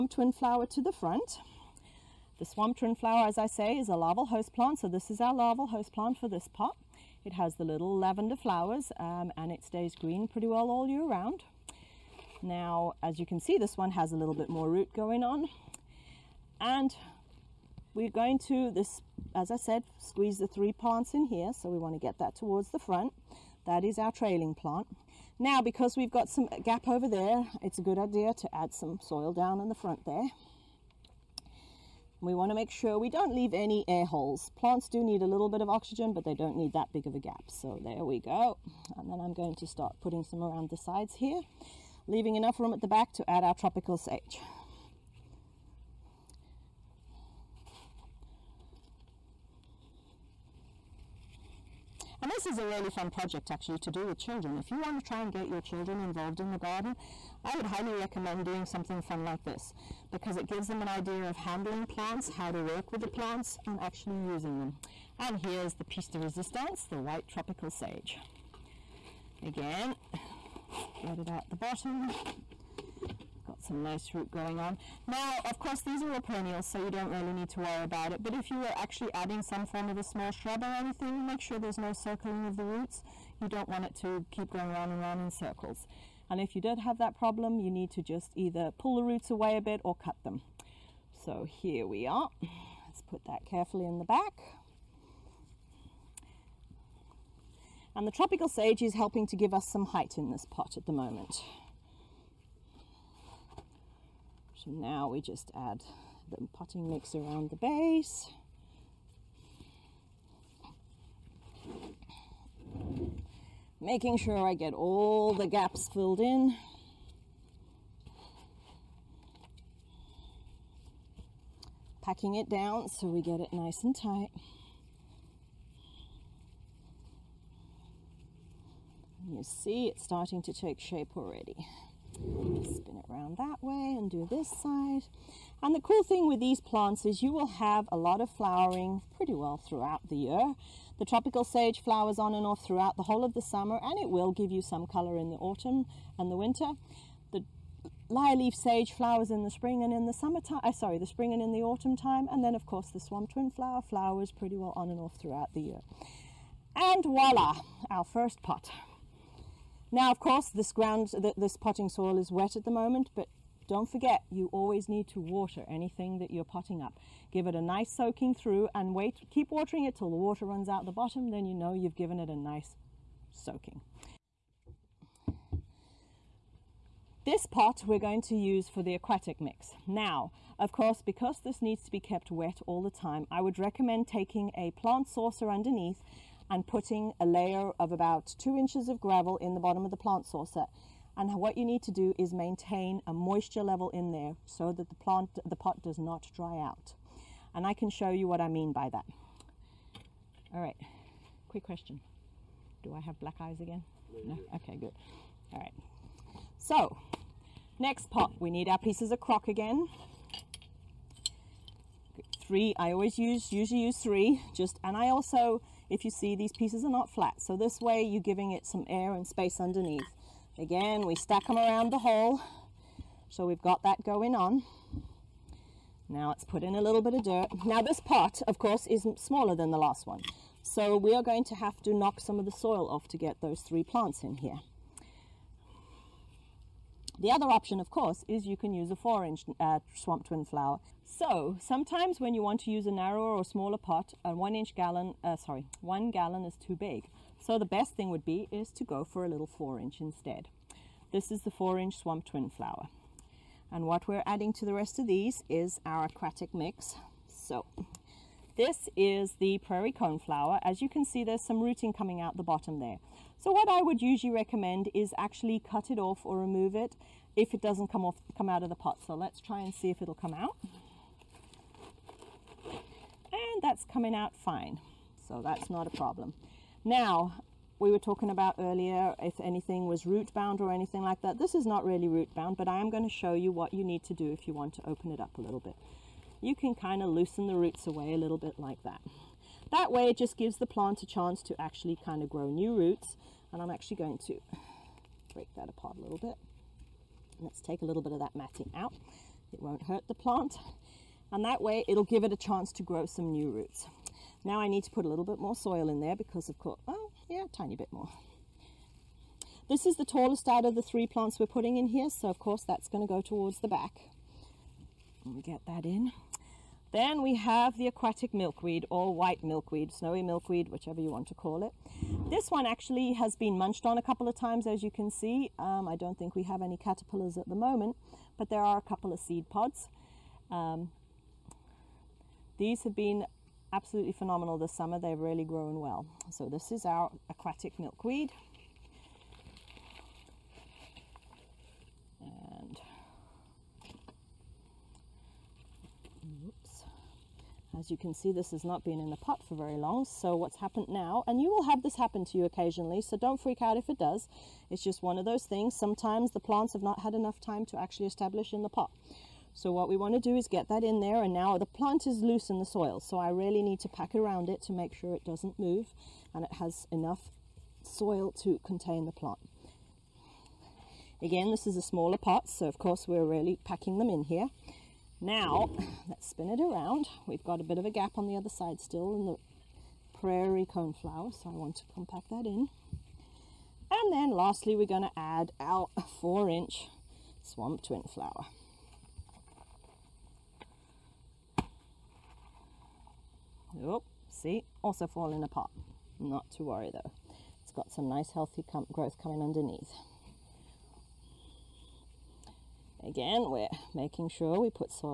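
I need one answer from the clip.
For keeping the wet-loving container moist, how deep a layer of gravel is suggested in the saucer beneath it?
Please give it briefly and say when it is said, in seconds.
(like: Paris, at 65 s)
2 inches, at 188 s.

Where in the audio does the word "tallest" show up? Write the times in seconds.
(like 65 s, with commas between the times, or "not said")
310 s.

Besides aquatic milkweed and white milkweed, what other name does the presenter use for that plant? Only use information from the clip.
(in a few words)
snowy milkweed.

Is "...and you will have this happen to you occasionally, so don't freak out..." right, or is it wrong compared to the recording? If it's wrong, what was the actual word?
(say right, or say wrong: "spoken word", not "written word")
right.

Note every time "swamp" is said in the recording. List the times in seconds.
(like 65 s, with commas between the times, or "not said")
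2 s, 153 s, 239 s, 251 s, 387 s.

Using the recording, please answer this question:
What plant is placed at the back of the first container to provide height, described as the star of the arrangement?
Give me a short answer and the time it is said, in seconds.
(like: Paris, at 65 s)
white tropical sage, at 66 s.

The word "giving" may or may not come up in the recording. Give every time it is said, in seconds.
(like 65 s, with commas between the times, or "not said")
218 s.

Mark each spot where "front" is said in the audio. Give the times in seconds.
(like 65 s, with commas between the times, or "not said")
0 s, 22 s, 29 s.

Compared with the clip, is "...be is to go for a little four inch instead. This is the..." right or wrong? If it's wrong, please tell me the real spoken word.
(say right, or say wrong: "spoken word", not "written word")
right.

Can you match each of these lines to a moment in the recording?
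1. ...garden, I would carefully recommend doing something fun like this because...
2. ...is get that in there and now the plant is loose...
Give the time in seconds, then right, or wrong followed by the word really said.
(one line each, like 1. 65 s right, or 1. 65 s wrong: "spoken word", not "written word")
1. 56 s wrong: "highly", not "carefully"
2. 360 s right.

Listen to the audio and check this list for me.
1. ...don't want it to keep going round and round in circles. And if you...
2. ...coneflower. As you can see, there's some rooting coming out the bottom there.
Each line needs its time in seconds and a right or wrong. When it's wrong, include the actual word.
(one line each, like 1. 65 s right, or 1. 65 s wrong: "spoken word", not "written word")
1. 83 s right
2. 259 s right.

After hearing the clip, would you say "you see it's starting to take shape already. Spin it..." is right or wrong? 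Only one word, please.
right.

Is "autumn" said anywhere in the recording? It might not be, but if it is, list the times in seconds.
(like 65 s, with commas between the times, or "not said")
145 s, 151 s.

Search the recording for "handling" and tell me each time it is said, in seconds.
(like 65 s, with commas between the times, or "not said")
61 s.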